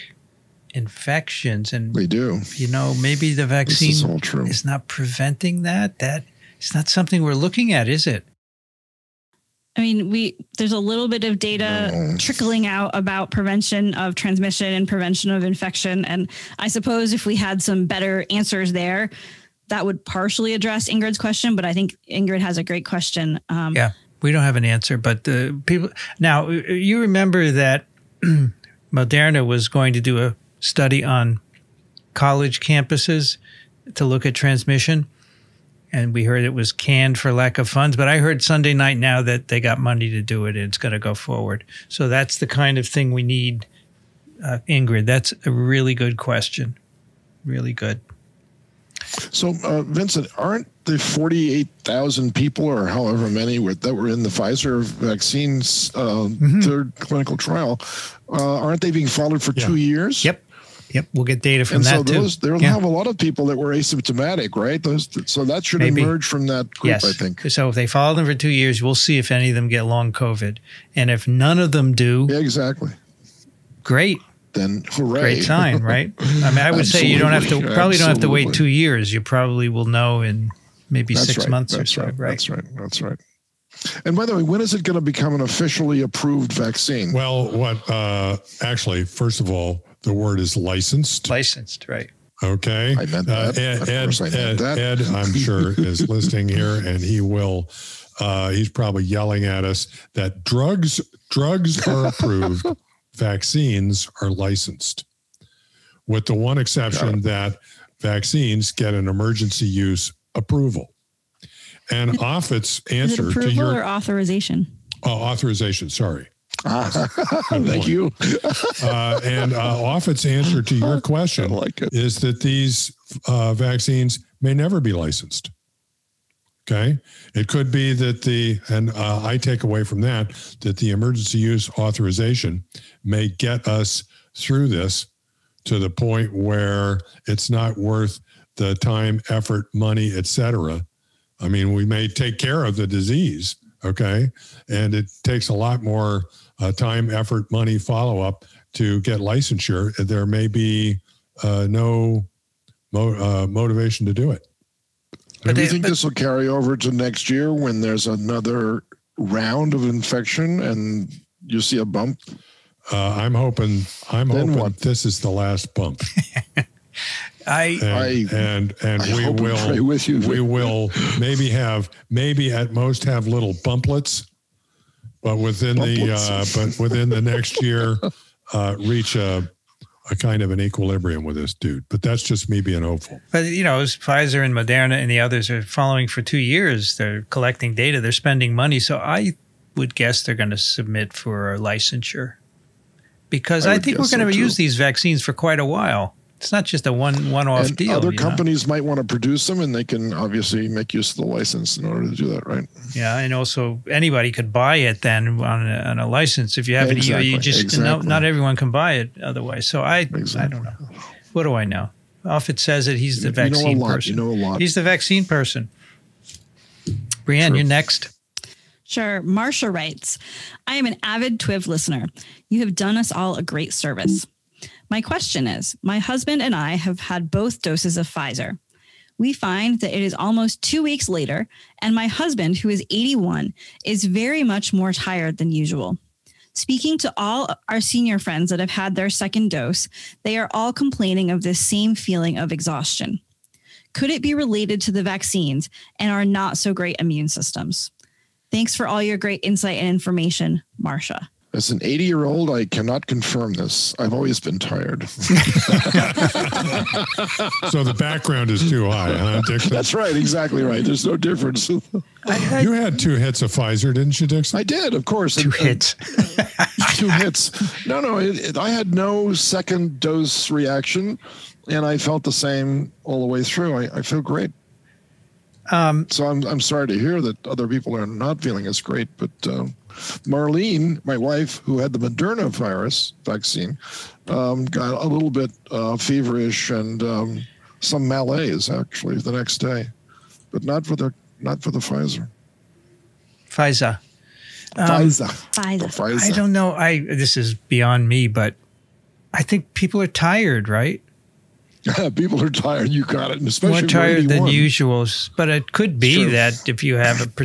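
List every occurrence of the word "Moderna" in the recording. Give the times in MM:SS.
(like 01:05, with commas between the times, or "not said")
00:28, 03:04, 04:41.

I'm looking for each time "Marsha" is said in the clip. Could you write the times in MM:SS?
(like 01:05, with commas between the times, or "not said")
03:39, 04:10.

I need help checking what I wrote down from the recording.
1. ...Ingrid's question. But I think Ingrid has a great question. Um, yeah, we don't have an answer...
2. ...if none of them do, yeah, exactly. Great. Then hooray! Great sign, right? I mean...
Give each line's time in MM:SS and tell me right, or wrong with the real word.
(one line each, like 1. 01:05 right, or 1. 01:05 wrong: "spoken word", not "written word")
1. 00:20 right
2. 01:11 right.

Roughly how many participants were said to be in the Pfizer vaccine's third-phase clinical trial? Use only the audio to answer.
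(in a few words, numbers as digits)
48,000.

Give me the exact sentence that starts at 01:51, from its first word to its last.
And Offit's answer is it approval to your or authorization.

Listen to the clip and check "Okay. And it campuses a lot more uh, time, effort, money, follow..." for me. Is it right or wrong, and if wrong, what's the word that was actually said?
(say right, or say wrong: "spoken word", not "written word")
wrong: "takes", not "campuses".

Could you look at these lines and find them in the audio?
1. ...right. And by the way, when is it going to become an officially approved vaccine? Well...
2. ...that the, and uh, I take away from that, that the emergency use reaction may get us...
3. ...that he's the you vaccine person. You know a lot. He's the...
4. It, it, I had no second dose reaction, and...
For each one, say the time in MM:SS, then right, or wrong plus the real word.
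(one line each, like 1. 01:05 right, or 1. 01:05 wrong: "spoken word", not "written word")
1. 01:23 right
2. 02:07 wrong: "authorization", not "reaction"
3. 03:32 right
4. 04:28 right.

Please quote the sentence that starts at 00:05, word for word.
That it's not something we're looking at, is it?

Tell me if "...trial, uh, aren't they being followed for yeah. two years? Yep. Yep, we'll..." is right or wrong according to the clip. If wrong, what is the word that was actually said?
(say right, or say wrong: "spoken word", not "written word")
right.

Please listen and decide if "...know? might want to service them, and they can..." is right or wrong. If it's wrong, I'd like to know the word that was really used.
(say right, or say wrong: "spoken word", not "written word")
wrong: "produce", not "service".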